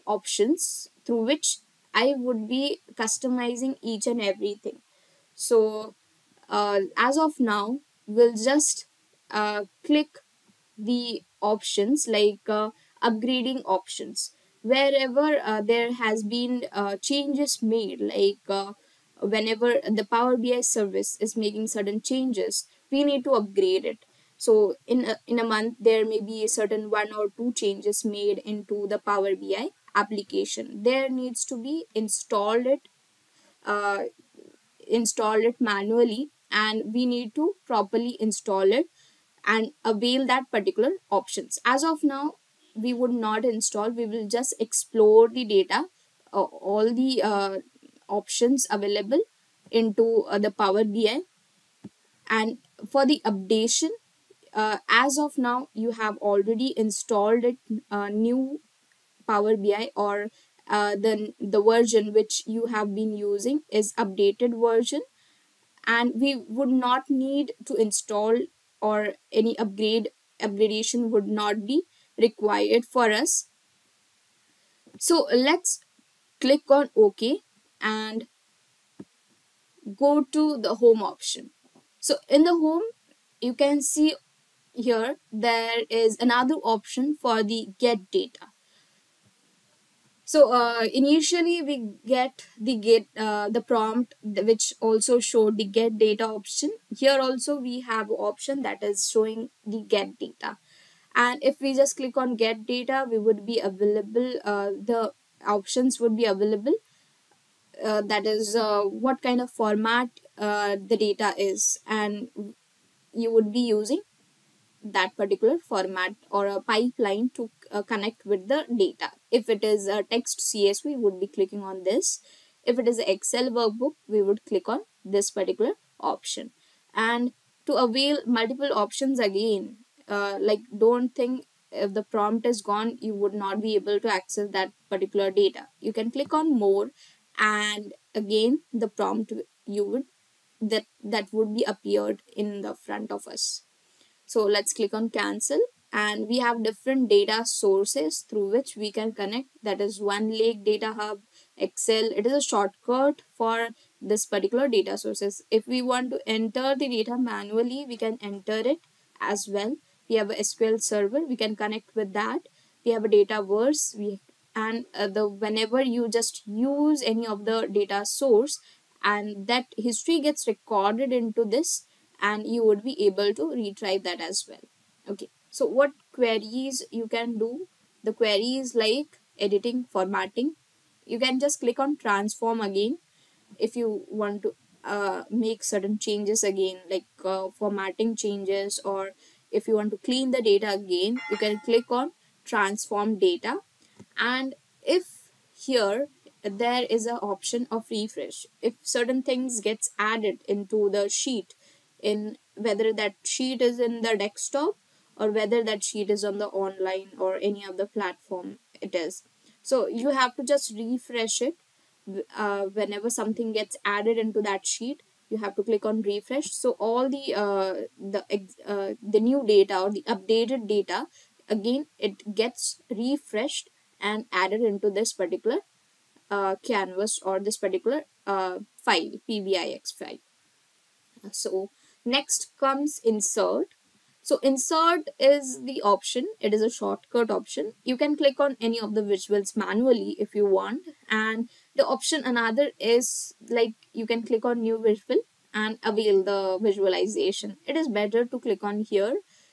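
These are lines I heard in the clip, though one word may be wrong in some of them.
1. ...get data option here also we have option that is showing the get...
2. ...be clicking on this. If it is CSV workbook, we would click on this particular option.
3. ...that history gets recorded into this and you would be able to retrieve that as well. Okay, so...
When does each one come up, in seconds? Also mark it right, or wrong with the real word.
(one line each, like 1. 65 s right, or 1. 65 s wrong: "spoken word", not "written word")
1. 95 s right
2. 121 s wrong: "Excel", not "CSV"
3. 169 s right.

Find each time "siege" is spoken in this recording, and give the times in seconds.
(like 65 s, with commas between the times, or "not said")
not said.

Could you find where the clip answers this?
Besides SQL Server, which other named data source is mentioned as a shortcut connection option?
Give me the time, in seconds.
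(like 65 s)
163 s.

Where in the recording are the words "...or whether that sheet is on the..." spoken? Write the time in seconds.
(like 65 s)
205 s.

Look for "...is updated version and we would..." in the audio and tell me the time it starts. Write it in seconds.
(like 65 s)
63 s.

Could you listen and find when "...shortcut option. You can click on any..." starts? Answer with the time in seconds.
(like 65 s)
236 s.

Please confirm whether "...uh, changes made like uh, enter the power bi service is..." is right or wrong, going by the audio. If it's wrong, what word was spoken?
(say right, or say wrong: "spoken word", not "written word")
wrong: "whenever", not "enter".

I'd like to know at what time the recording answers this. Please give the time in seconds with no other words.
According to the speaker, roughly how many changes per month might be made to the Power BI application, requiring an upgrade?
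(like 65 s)
26 s.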